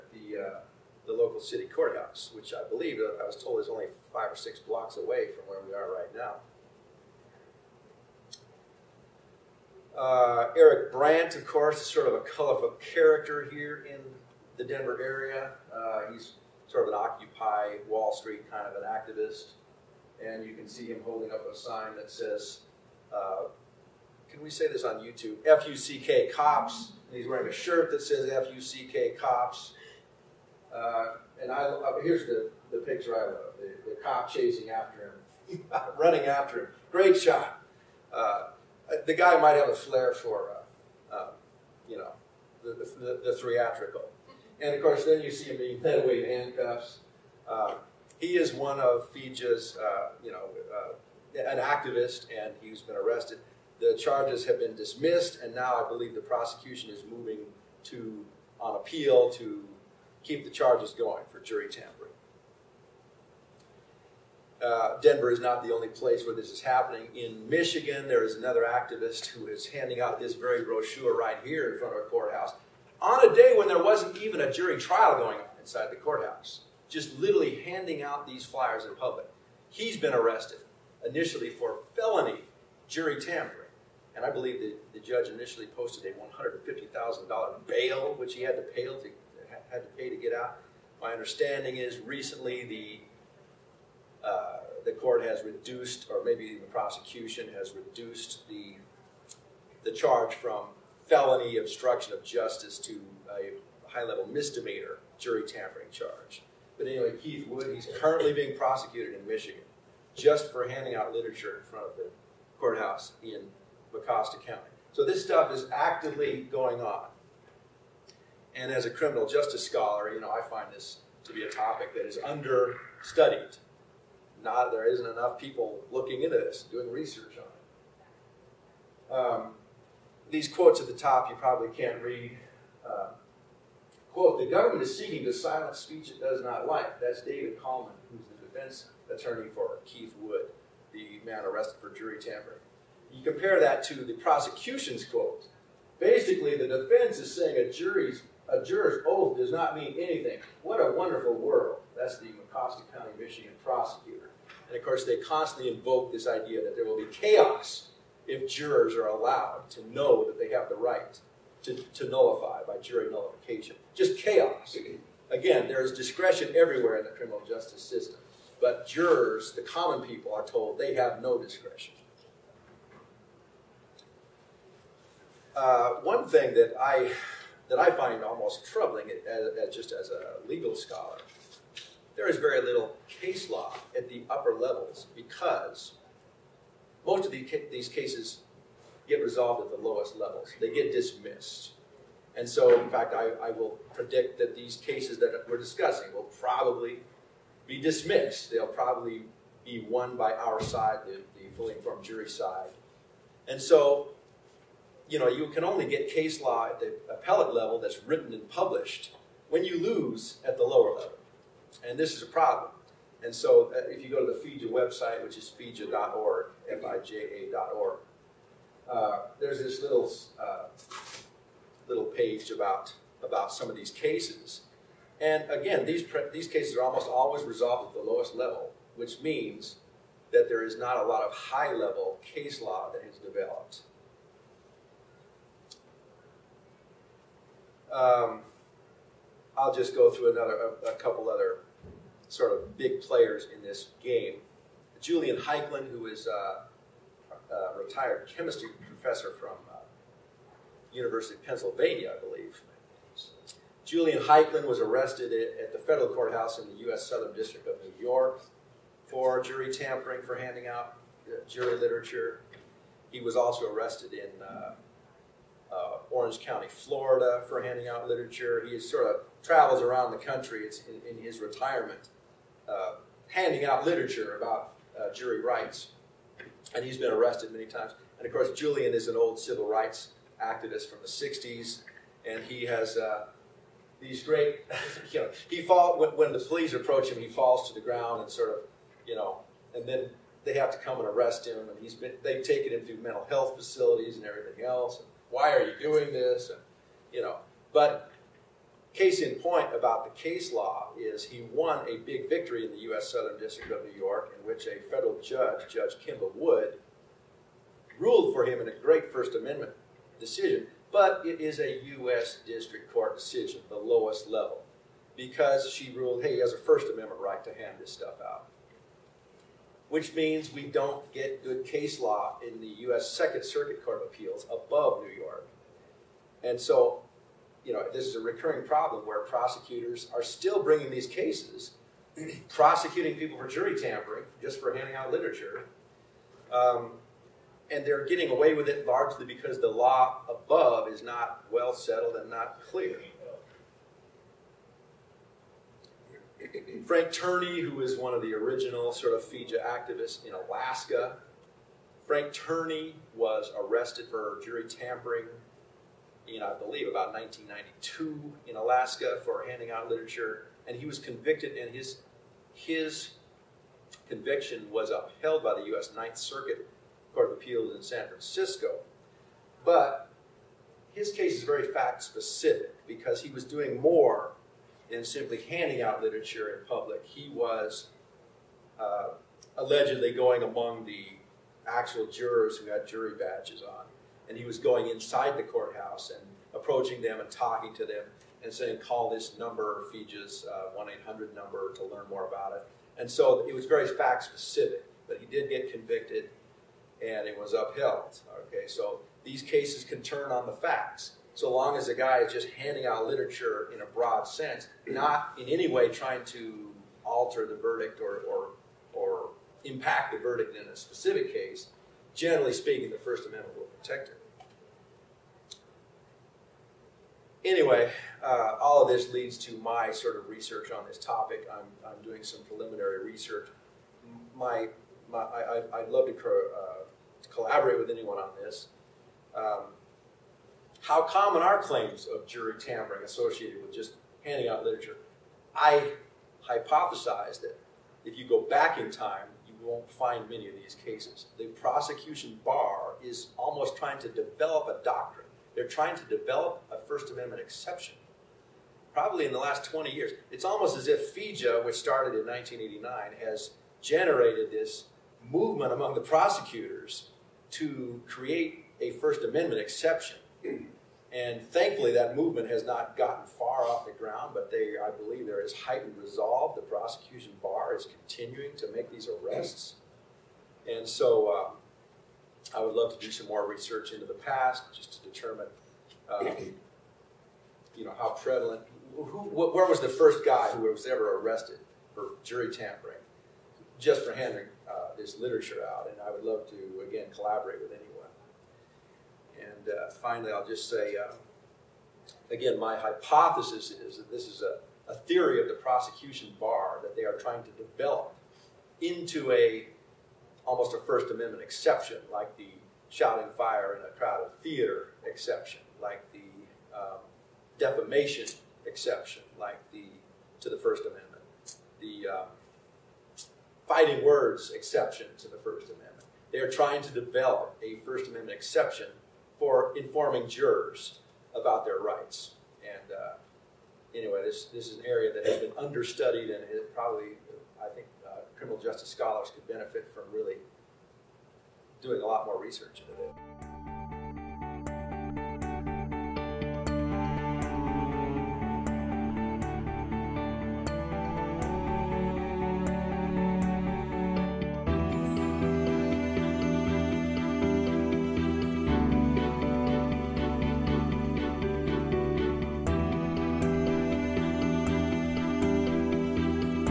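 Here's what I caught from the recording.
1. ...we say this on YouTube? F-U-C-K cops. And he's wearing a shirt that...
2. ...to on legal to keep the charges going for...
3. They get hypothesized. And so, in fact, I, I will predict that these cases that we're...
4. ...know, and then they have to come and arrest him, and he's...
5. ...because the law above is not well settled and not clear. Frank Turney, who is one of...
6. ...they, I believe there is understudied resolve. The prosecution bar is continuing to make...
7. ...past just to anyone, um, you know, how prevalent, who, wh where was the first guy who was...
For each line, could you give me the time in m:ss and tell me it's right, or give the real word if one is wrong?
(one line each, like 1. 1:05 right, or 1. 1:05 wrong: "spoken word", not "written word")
1. 0:24 right
2. 0:57 wrong: "appeal", not "legal"
3. 3:10 wrong: "dismissed", not "hypothesized"
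4. 4:49 right
5. 5:39 right
6. 7:44 wrong: "heightened", not "understudied"
7. 7:54 wrong: "determine", not "anyone".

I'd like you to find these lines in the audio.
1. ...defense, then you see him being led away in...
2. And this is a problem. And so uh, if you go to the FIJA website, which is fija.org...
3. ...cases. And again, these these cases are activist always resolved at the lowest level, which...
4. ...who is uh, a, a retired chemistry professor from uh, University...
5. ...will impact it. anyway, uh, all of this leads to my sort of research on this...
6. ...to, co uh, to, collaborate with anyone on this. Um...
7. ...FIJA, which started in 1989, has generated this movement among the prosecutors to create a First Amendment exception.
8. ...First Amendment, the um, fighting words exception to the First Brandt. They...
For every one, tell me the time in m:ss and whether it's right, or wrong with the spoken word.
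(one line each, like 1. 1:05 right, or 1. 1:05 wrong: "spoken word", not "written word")
1. 0:44 wrong: "course", not "defense"
2. 3:31 right
3. 3:43 wrong: "almost", not "activist"
4. 4:05 right
5. 6:53 wrong: "protect", not "impact"
6. 7:06 right
7. 7:31 right
8. 8:30 wrong: "Amendment", not "Brandt".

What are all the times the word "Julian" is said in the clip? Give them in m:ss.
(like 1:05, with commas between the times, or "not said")
4:04, 4:13, 4:38.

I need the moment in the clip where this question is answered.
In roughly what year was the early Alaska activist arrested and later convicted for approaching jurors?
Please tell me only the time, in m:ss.
5:57.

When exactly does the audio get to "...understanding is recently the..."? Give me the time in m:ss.
1:31.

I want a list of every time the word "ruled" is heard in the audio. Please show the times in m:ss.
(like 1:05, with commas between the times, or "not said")
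5:07, 5:15.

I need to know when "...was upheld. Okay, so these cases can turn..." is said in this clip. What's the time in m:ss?
6:37.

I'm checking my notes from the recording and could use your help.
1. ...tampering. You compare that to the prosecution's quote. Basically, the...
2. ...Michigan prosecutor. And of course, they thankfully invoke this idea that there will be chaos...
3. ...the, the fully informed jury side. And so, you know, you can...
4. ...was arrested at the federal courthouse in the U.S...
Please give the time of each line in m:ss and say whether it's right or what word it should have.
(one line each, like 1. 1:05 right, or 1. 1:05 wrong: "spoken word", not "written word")
1. 2:22 right
2. 2:33 wrong: "constantly", not "thankfully"
3. 3:21 right
4. 4:14 right.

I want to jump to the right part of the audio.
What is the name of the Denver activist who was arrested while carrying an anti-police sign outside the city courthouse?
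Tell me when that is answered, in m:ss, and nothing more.
0:10.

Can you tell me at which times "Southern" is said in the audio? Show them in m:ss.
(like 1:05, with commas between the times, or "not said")
4:17, 5:03.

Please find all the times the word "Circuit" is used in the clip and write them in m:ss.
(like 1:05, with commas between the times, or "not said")
5:23, 6:06.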